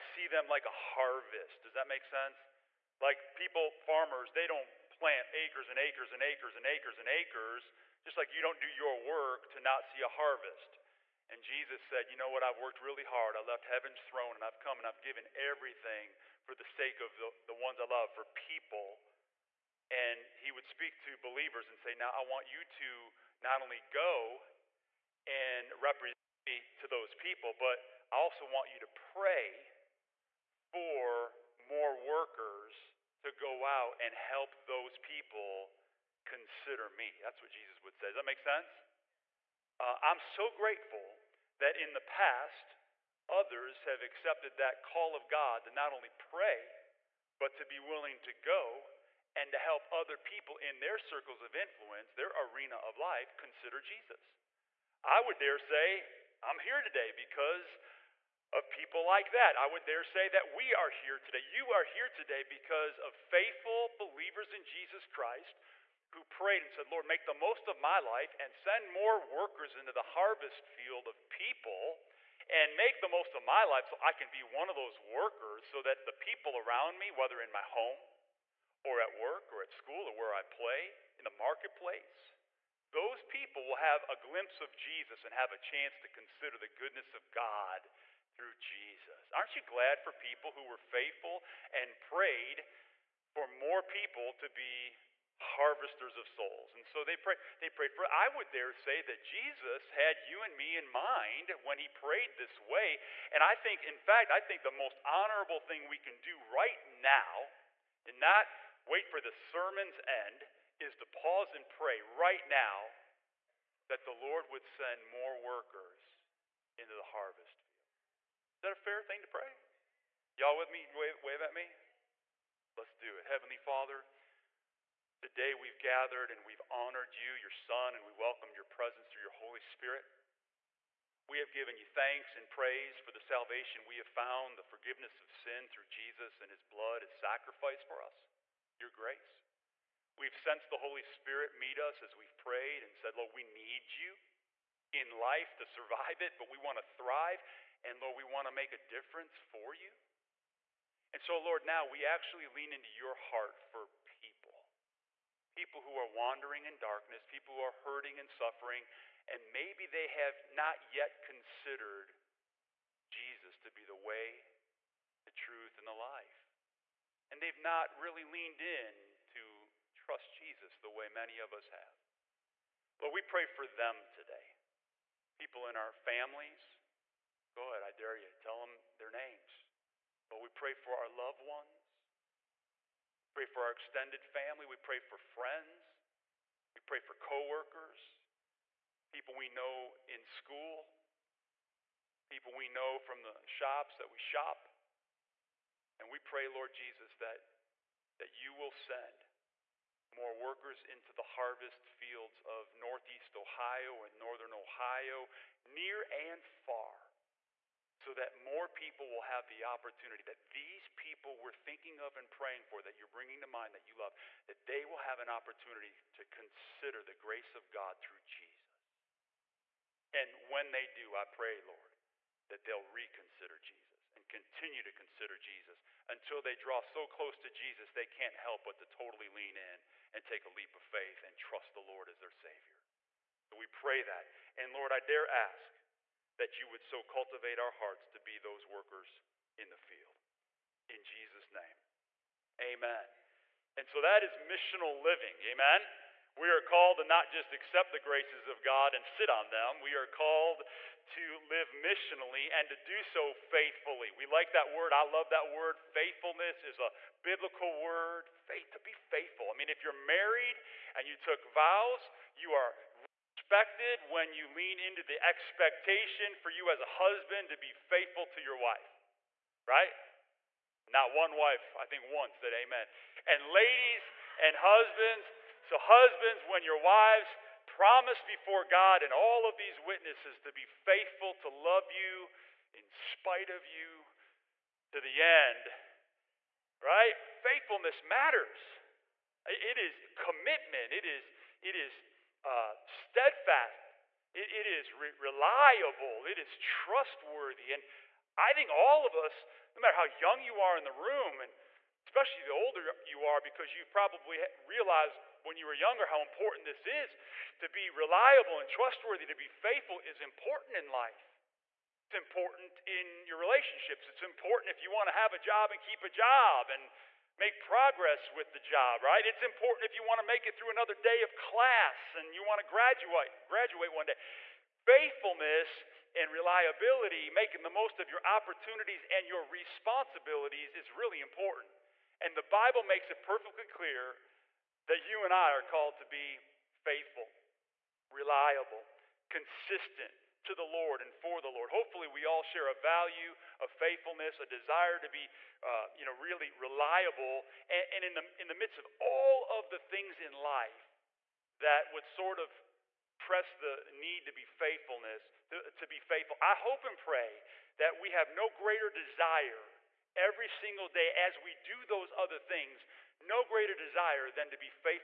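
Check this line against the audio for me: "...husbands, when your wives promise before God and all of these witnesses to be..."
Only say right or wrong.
right.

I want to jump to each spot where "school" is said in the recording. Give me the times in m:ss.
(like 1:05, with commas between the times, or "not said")
1:19, 3:10.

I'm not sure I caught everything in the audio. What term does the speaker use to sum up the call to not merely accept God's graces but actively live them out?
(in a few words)
missional living.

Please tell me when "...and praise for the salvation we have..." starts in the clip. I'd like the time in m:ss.
2:12.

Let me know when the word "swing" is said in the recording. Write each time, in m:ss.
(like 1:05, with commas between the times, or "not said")
not said.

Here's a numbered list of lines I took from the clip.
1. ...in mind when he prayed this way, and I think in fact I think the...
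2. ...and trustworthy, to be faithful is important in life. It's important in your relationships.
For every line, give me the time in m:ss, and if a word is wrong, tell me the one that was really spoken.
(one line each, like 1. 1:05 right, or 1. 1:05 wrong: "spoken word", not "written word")
1. 1:40 right
2. 5:08 right.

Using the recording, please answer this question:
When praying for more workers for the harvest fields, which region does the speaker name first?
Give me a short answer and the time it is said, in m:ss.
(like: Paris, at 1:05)
Northeast Ohio, at 3:22.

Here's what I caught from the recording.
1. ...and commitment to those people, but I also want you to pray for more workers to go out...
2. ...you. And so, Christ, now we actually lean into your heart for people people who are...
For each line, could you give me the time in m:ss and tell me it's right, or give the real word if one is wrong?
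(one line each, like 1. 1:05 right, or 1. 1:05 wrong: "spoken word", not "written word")
1. 0:25 wrong: "represent", not "commitment"
2. 2:29 wrong: "Lord", not "Christ".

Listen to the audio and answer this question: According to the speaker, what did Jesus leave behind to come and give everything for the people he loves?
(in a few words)
heaven's throne.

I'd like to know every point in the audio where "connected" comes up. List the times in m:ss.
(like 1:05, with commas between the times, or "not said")
not said.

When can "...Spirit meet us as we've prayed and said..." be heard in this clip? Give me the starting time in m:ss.
2:21.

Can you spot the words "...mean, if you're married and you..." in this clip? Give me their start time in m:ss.
4:19.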